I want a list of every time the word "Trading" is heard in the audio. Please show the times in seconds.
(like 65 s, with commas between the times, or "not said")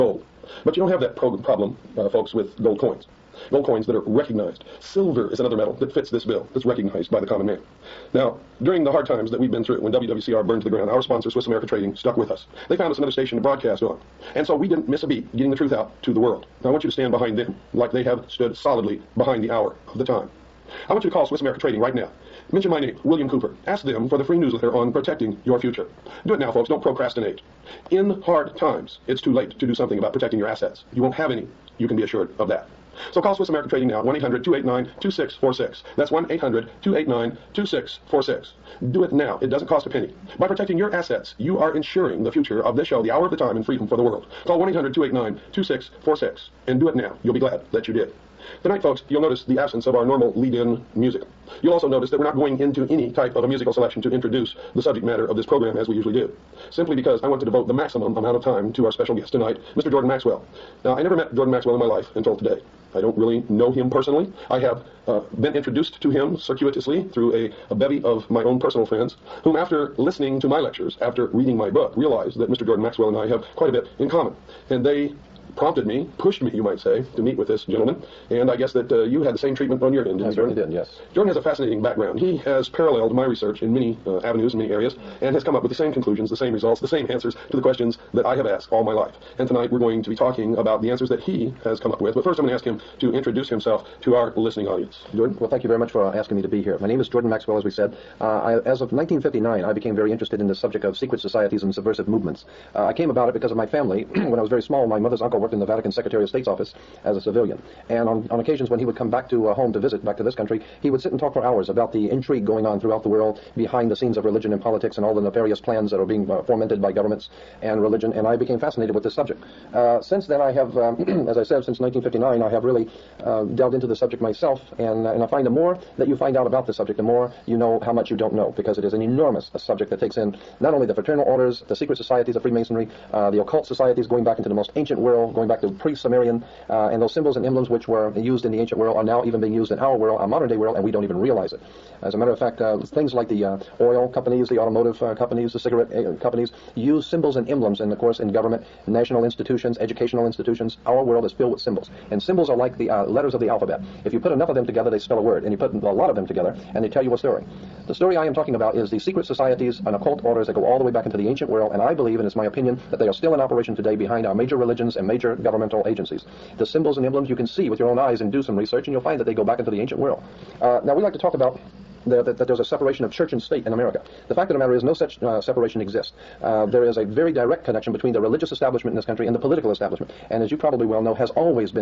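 11 s, 21 s, 33 s.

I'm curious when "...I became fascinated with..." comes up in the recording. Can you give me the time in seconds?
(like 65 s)
118 s.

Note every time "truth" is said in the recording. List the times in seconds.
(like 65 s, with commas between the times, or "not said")
15 s.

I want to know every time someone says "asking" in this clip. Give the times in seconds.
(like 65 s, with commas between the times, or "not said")
96 s.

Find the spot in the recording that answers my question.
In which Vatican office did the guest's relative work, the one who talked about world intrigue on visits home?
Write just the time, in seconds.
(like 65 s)
105 s.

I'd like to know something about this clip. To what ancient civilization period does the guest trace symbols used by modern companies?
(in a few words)
pre-Sumerian.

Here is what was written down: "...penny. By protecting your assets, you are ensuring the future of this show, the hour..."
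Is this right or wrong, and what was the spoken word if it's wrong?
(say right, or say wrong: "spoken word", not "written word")
right.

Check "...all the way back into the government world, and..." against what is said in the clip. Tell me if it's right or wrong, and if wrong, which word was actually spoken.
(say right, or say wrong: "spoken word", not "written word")
wrong: "ancient", not "government".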